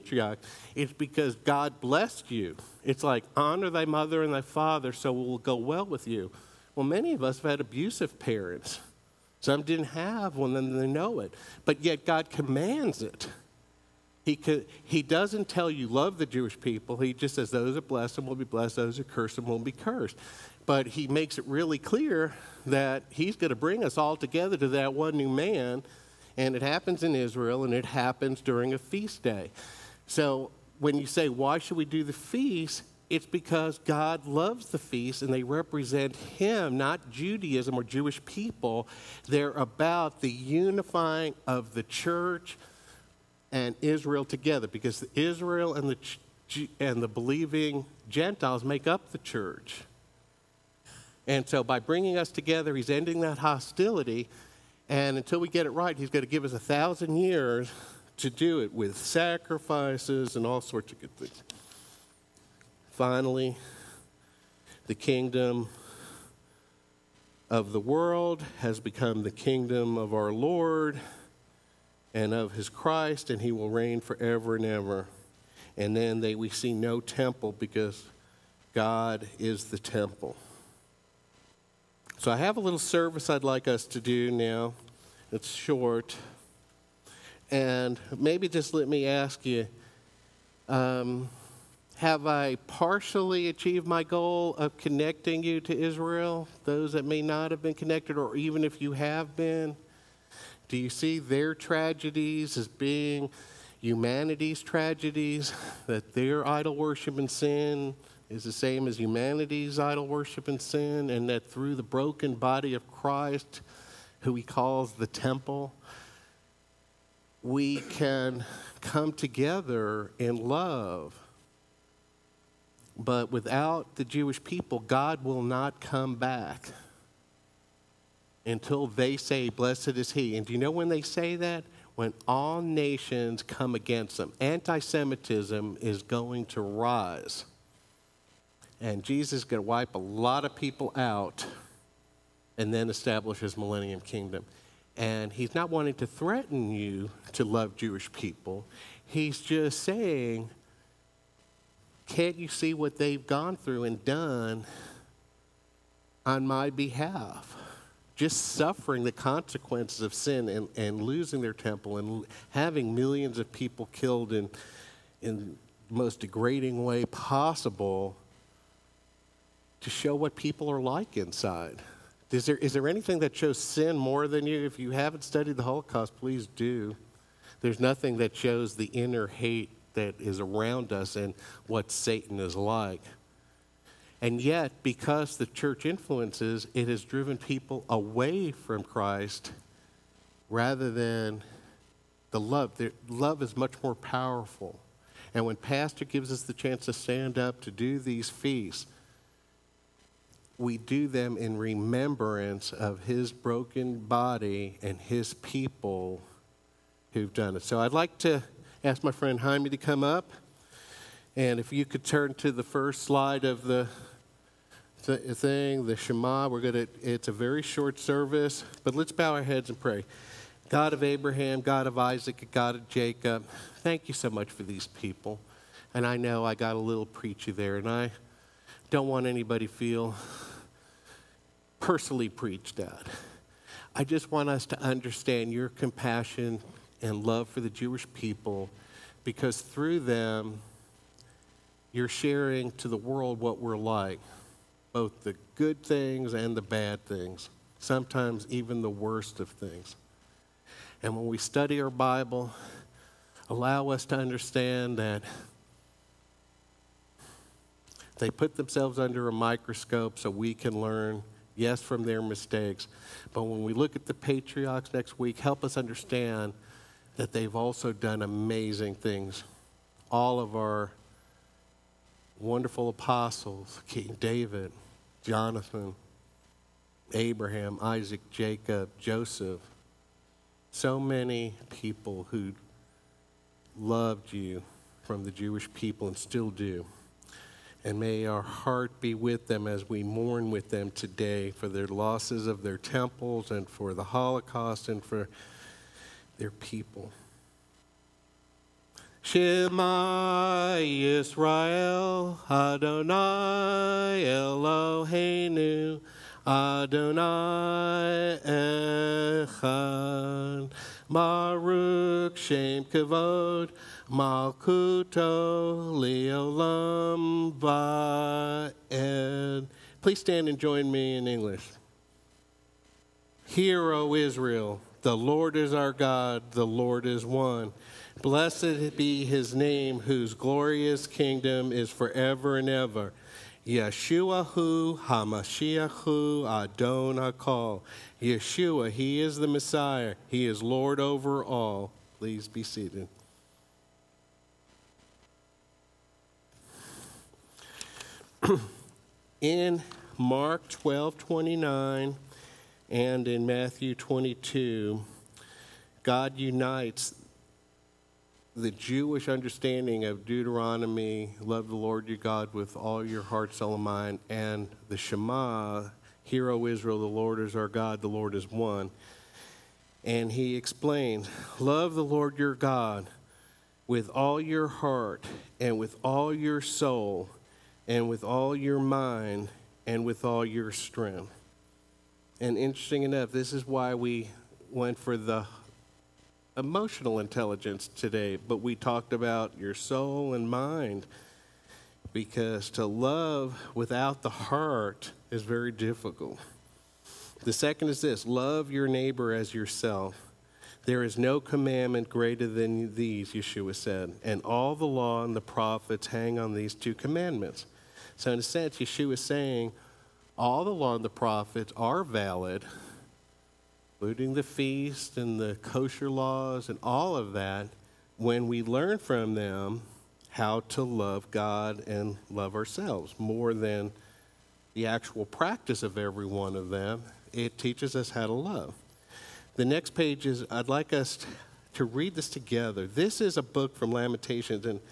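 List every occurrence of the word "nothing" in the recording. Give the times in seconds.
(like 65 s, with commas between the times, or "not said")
177 s.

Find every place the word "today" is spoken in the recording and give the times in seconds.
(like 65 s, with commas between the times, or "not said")
290 s, 387 s.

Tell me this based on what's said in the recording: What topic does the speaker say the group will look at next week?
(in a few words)
The patriarchs.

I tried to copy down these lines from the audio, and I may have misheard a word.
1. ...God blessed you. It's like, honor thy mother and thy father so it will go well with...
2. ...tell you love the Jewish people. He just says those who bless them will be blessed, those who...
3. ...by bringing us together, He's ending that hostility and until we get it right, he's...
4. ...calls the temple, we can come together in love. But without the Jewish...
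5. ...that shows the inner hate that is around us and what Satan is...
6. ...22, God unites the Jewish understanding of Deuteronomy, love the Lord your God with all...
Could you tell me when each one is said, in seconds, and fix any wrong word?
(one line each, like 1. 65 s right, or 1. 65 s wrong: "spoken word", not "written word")
1. 1 s right
2. 15 s right
3. 51 s right
4. 114 s right
5. 178 s right
6. 353 s right.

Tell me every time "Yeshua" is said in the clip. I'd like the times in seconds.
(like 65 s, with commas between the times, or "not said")
333 s, 338 s, 403 s, 408 s.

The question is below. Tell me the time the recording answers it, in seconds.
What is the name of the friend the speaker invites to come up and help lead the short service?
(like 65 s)
209 s.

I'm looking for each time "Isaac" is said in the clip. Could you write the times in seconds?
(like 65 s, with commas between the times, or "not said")
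221 s, 277 s.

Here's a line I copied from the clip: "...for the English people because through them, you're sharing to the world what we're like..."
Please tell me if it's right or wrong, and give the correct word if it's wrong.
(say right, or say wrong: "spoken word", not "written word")
wrong: "Jewish", not "English".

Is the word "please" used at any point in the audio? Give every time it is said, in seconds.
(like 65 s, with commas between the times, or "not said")
176 s, 320 s, 342 s.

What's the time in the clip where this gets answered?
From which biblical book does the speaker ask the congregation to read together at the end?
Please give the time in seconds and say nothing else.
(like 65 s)
433 s.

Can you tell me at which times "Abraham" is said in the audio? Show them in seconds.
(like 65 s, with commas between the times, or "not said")
221 s, 277 s.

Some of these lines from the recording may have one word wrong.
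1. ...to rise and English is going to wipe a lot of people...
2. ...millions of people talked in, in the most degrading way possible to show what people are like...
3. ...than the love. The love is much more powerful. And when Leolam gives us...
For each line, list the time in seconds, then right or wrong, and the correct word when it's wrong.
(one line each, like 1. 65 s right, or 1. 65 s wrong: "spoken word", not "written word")
1. 136 s wrong: "Jesus", not "English"
2. 162 s wrong: "killed", not "talked"
3. 190 s wrong: "Pastor", not "Leolam".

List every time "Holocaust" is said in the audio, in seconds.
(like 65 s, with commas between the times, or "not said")
175 s, 294 s.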